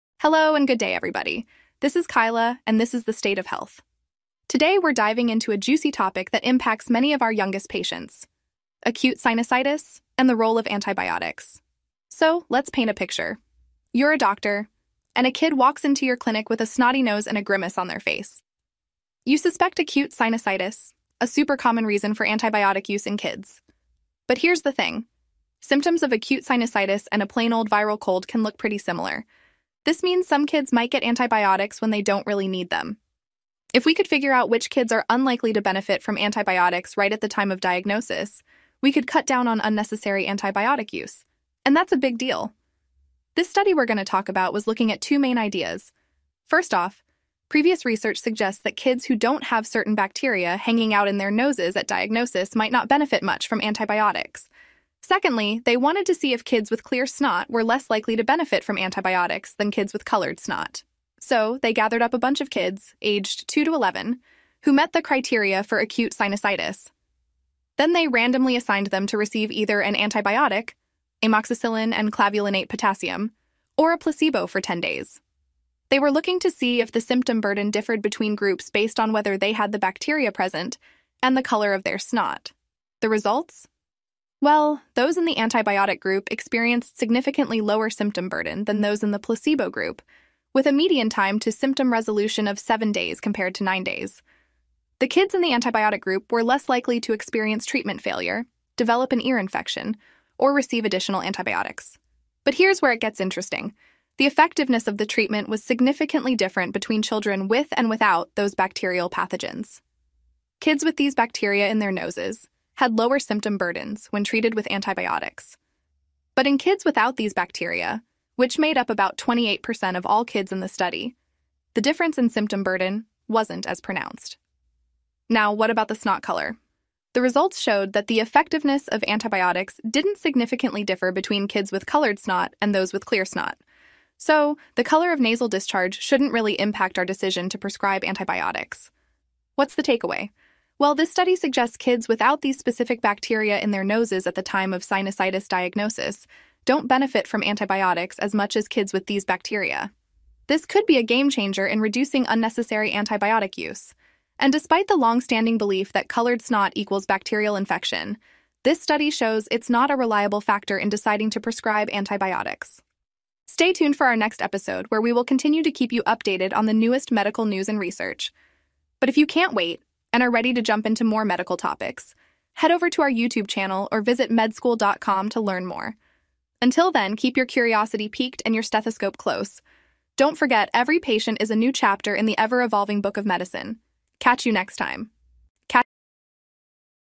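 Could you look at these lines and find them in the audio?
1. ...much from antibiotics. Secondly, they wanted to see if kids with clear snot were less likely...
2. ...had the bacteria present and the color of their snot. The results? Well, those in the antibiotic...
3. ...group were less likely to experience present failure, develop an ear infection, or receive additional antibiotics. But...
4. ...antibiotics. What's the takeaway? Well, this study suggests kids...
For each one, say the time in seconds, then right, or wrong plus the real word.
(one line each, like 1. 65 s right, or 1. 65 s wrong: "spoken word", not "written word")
1. 53 s right
2. 79 s right
3. 96 s wrong: "treatment", not "present"
4. 138 s right.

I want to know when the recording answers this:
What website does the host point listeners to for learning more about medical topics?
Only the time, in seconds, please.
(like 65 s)
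174 s.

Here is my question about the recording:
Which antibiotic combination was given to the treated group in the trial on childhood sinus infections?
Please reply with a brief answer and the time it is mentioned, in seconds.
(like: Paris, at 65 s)
Amoxicillin and clavulanate potassium, at 71 s.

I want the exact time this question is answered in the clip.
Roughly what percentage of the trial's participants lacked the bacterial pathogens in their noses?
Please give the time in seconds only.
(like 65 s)
119 s.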